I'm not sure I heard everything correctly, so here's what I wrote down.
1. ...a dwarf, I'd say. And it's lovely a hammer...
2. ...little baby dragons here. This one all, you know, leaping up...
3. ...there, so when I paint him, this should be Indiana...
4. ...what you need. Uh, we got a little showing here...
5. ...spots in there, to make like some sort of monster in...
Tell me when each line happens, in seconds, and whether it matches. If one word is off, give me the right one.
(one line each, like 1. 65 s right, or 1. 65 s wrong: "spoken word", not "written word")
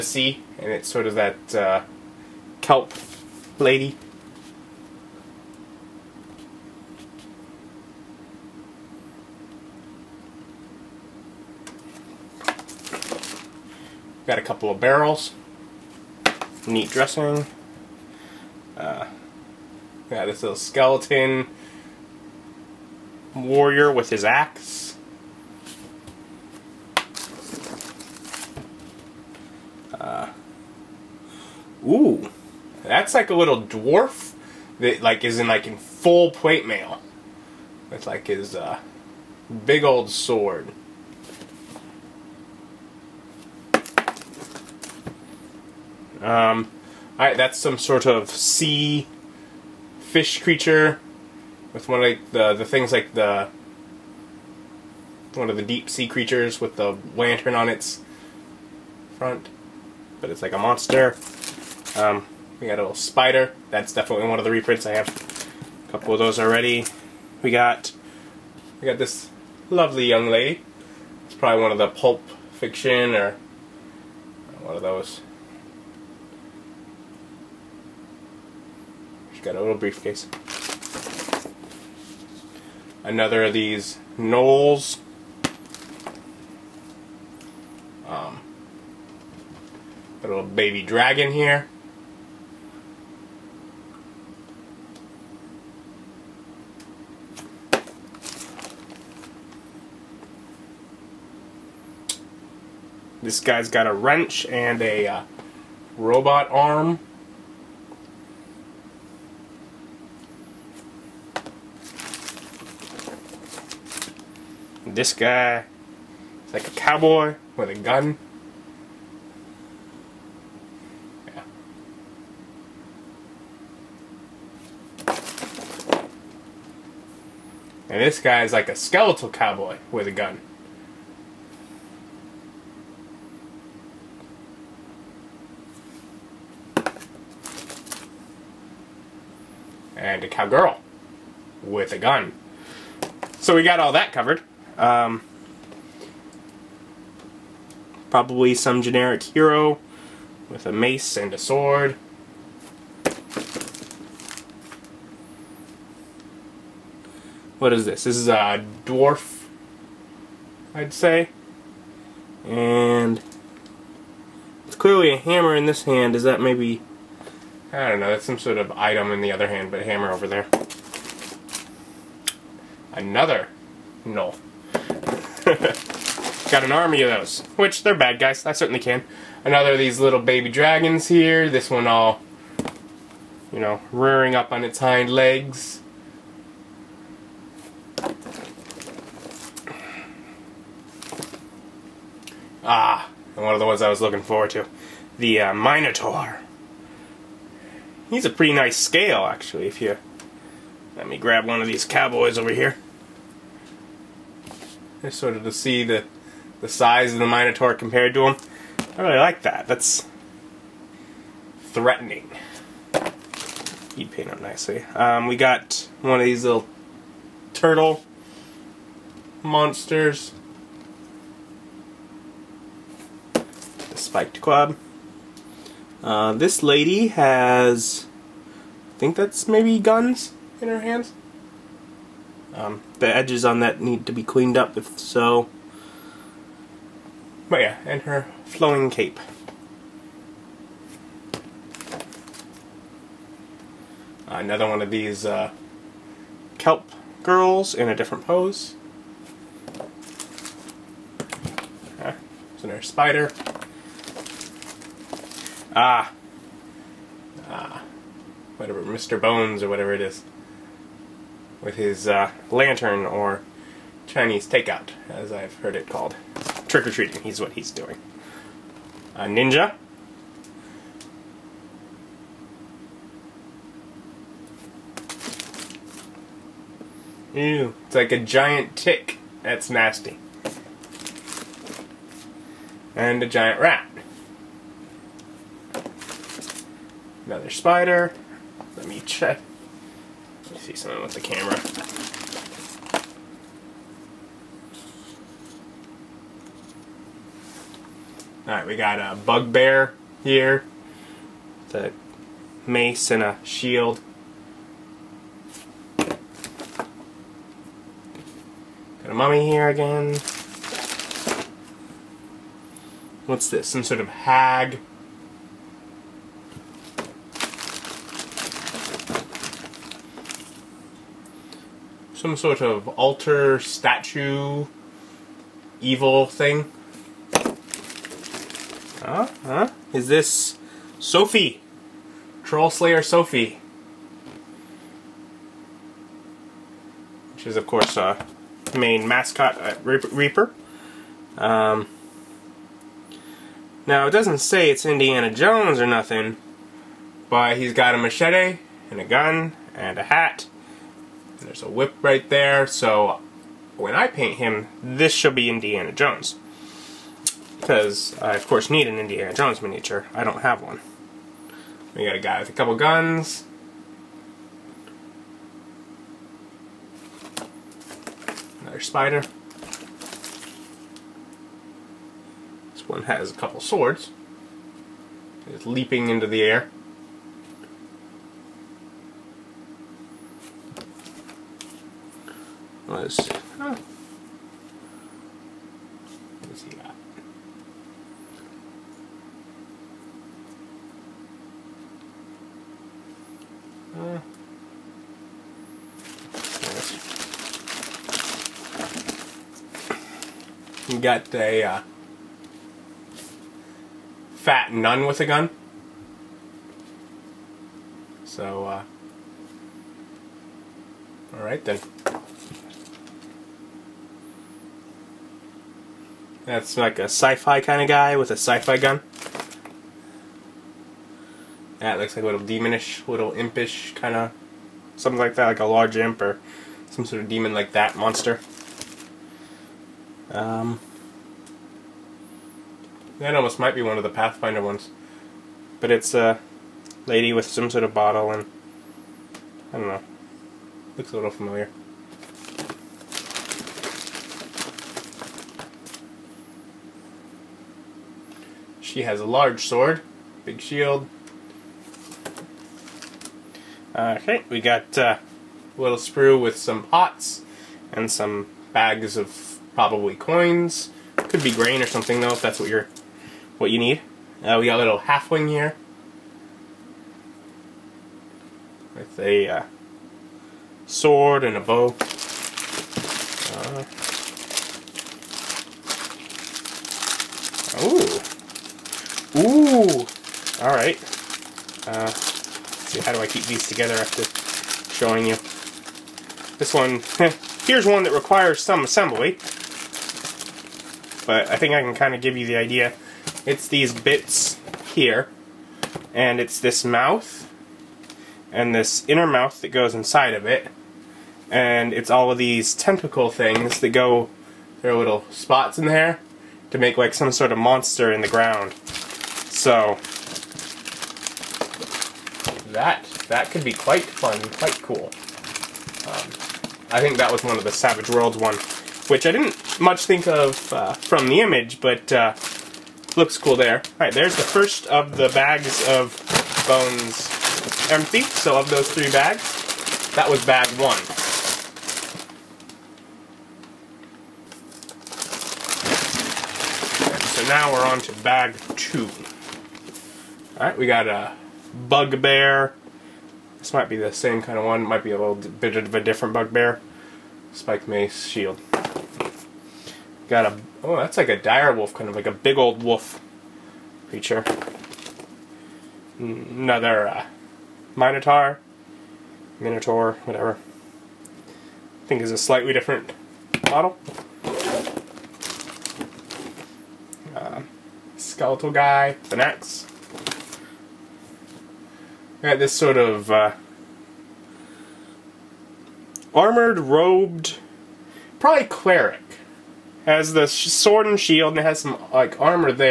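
1. 158 s wrong: "clearly", not "lovely"
2. 179 s wrong: "rearing", not "leaping"
3. 352 s right
4. 463 s wrong: "halfling", not "showing"
5. 505 s right.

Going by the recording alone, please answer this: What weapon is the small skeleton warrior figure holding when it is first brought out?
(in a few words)
axe.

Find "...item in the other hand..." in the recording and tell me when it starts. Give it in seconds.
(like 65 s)
168 s.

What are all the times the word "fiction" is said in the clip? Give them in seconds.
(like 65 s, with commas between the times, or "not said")
72 s.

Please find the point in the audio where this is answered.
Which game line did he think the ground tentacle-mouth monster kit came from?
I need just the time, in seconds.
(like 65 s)
517 s.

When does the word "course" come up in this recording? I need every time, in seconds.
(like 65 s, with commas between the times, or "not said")
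337 s, 358 s.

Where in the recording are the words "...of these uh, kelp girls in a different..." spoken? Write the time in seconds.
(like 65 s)
244 s.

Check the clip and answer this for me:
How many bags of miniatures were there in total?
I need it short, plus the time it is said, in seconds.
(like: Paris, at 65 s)
3, at 528 s.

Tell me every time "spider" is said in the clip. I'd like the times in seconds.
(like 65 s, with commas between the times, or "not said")
62 s, 252 s, 287 s, 368 s.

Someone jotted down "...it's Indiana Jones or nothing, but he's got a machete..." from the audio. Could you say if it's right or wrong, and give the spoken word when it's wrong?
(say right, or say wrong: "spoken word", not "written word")
right.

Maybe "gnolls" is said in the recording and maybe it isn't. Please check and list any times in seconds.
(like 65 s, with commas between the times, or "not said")
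84 s, 174 s.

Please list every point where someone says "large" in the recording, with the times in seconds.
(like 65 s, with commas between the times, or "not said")
425 s, 449 s.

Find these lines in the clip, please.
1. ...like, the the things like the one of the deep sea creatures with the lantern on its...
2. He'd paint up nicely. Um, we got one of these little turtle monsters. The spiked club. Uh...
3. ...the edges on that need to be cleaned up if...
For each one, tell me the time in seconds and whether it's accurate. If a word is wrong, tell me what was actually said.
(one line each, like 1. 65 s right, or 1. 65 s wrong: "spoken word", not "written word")
1. 52 s right
2. 213 s right
3. 233 s right.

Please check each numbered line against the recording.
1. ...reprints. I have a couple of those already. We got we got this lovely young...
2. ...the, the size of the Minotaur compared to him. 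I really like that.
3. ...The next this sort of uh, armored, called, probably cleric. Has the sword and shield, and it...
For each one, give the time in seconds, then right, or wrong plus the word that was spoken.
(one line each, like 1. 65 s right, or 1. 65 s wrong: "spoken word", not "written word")
1. 64 s right
2. 205 s right
3. 569 s wrong: "robed", not "called".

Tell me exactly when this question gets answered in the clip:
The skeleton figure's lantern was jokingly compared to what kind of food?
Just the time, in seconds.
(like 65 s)
264 s.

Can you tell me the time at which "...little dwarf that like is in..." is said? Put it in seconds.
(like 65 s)
33 s.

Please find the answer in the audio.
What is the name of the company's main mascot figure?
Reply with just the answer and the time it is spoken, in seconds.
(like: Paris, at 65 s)
Troll Slayer Sophie, at 332 s.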